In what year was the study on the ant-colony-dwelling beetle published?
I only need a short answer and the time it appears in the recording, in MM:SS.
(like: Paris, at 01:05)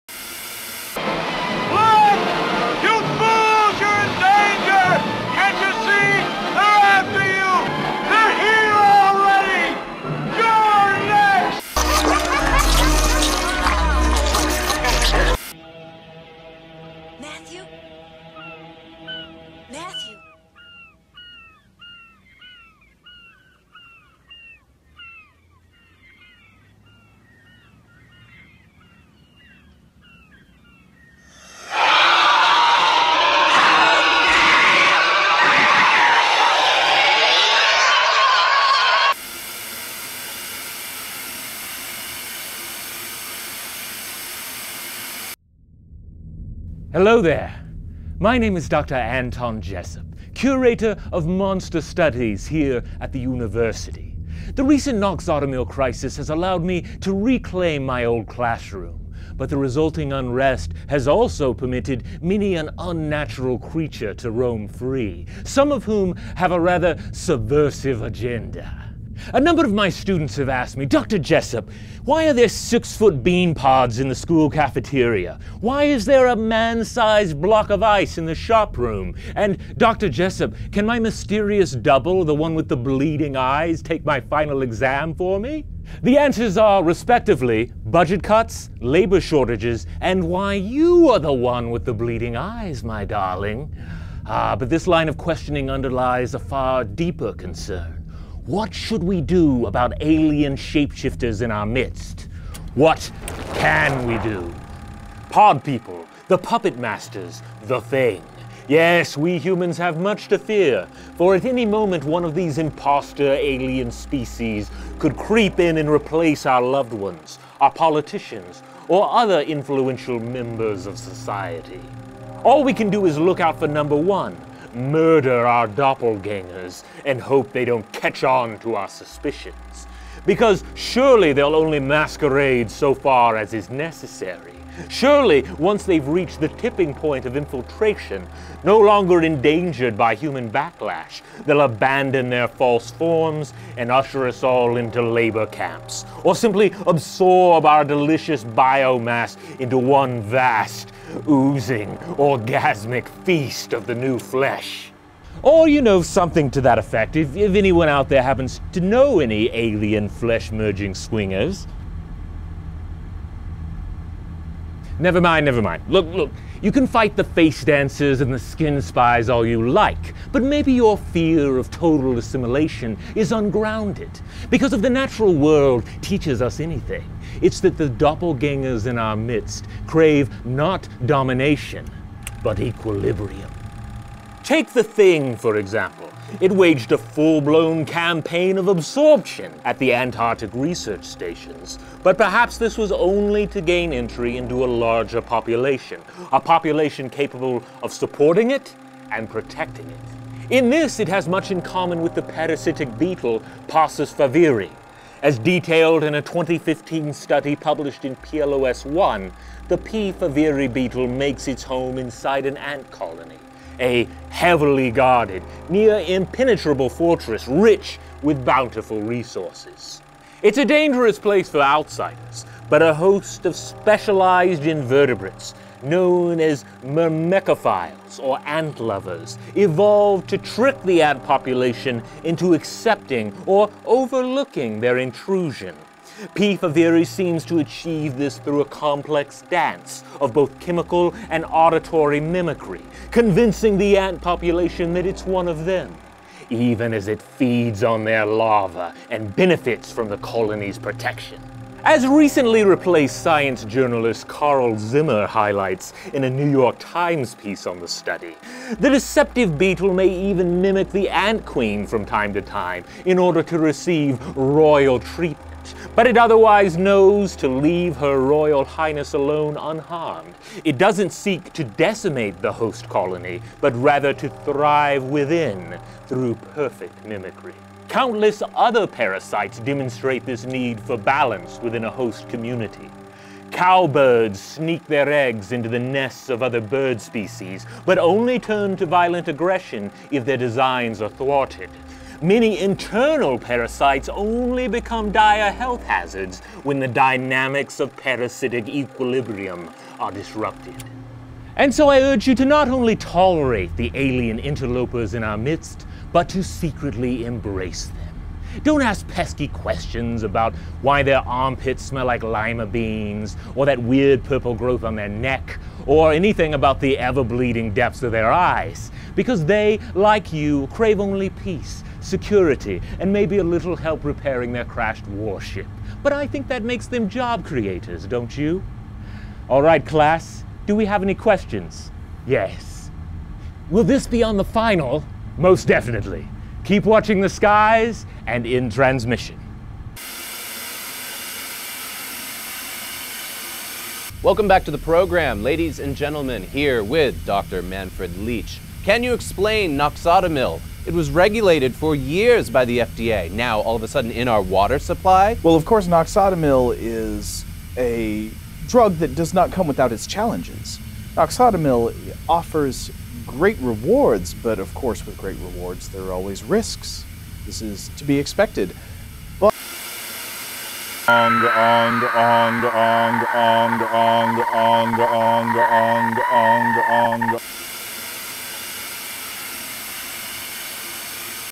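2015, at 03:26.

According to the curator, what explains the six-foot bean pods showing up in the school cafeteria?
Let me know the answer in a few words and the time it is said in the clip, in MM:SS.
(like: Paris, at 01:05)
Budget cuts, at 01:27.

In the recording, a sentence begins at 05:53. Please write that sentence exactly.
Now, all of a sudden, in our water supply?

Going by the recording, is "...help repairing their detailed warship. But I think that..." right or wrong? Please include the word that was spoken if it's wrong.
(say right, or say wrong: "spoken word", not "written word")
wrong: "crashed", not "detailed".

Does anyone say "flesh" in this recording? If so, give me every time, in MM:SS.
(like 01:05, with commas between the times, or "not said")
02:34, 02:40.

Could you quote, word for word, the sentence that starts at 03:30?
favieri beetle makes its home inside an ant colony a heavily guarded, near impenetrable fortress rich with bountiful resources.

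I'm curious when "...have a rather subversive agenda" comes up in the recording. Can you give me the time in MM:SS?
01:06.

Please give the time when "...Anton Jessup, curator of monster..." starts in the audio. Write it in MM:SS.
00:48.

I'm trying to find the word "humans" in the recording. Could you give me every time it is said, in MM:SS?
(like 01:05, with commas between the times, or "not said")
01:49, 02:20.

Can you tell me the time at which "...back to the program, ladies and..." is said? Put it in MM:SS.
05:44.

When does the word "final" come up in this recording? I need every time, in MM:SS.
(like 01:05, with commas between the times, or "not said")
01:24, 05:34.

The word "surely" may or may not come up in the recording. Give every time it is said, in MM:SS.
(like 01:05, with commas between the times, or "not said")
02:10, 02:14.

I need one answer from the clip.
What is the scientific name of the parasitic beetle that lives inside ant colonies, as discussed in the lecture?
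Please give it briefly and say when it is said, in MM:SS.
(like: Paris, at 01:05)
Paussus favieri, at 03:23.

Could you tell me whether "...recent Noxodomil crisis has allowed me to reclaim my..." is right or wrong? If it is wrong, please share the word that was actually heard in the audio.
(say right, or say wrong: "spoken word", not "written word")
right.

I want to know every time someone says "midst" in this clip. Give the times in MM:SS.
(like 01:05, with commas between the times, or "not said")
01:41, 02:59, 05:05.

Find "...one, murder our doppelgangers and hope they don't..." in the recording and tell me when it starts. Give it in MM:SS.
02:03.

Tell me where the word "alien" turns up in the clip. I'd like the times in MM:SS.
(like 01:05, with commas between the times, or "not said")
01:40, 01:53, 02:39, 05:03.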